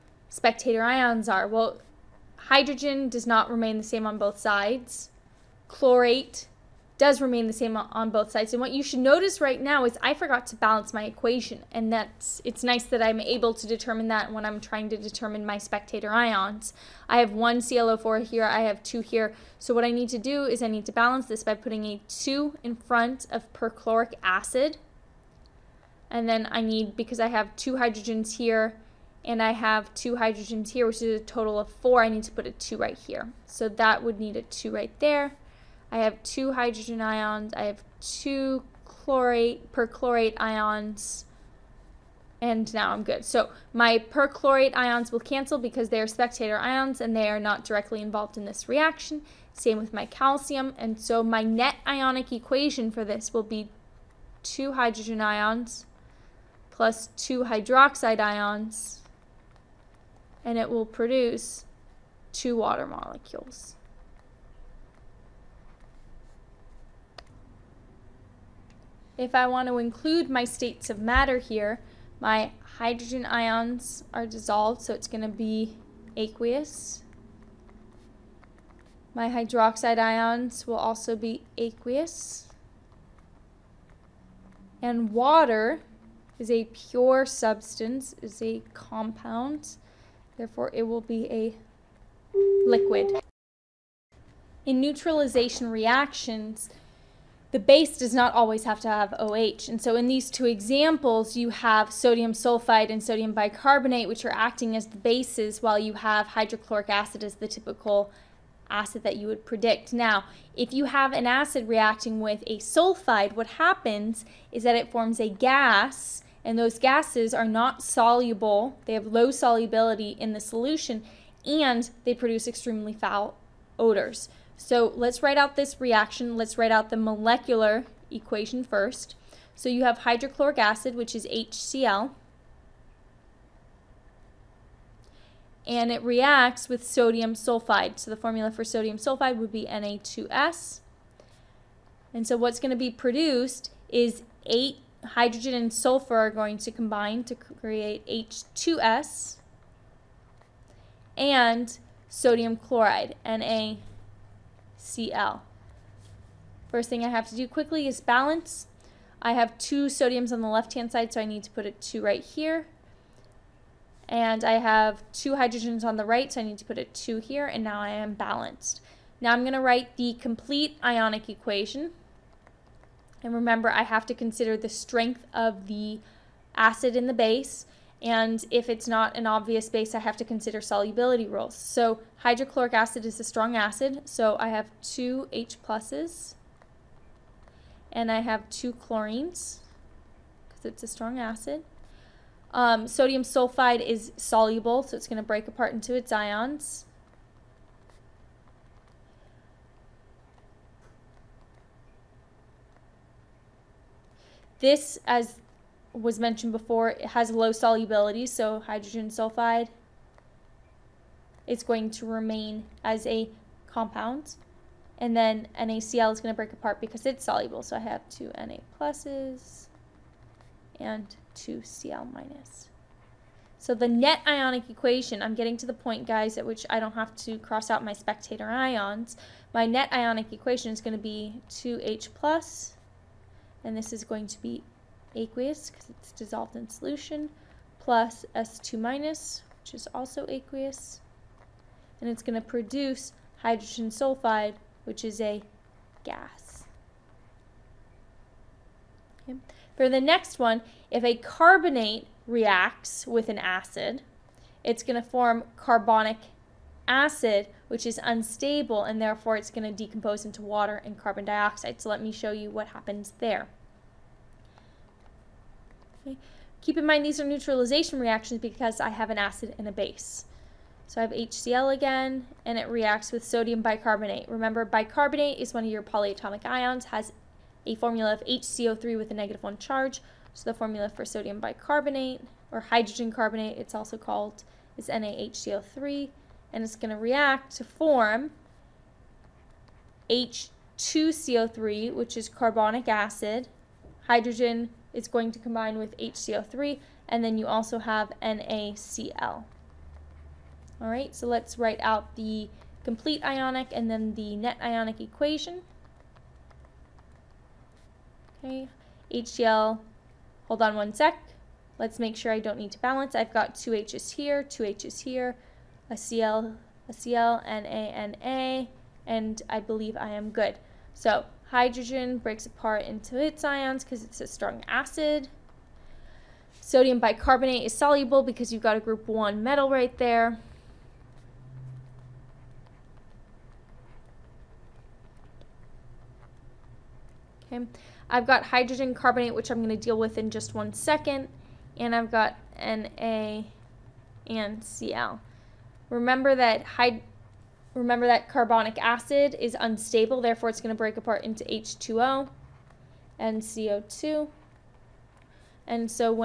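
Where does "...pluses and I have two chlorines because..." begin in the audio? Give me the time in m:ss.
3:05.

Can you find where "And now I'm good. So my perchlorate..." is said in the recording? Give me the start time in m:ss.
0:42.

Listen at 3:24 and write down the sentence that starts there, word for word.
This, as was mentioned before, it has low solubility, so hydrogen sulfide is going to remain as a compound.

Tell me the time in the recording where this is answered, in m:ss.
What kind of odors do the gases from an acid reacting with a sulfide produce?
2:02.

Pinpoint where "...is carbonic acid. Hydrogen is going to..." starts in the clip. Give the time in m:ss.
4:52.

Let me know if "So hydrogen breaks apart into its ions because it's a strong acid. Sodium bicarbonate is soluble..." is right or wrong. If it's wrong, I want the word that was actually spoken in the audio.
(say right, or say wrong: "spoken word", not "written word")
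right.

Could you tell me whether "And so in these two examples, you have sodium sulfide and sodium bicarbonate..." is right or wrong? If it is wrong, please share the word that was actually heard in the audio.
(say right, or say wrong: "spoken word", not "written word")
right.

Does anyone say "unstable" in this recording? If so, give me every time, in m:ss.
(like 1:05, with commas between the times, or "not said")
4:18, 5:49.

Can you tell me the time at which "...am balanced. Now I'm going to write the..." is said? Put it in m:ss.
2:47.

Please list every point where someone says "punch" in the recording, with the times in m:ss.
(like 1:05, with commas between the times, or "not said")
not said.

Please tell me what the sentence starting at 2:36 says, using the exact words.
First thing I have to do quickly is balance.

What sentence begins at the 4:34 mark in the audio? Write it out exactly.
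Remember, bicarbonate is one of your polyatomic ions, has a formula of HCO3 with a negative 1 charge.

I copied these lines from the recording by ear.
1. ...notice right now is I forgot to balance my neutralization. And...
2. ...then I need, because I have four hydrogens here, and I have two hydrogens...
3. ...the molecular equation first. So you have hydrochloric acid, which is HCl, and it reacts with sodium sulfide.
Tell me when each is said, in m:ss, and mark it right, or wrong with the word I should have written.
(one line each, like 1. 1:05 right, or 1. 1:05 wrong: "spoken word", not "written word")
1. 0:08 wrong: "equation", not "neutralization"
2. 0:26 wrong: "two", not "four"
3. 2:06 right.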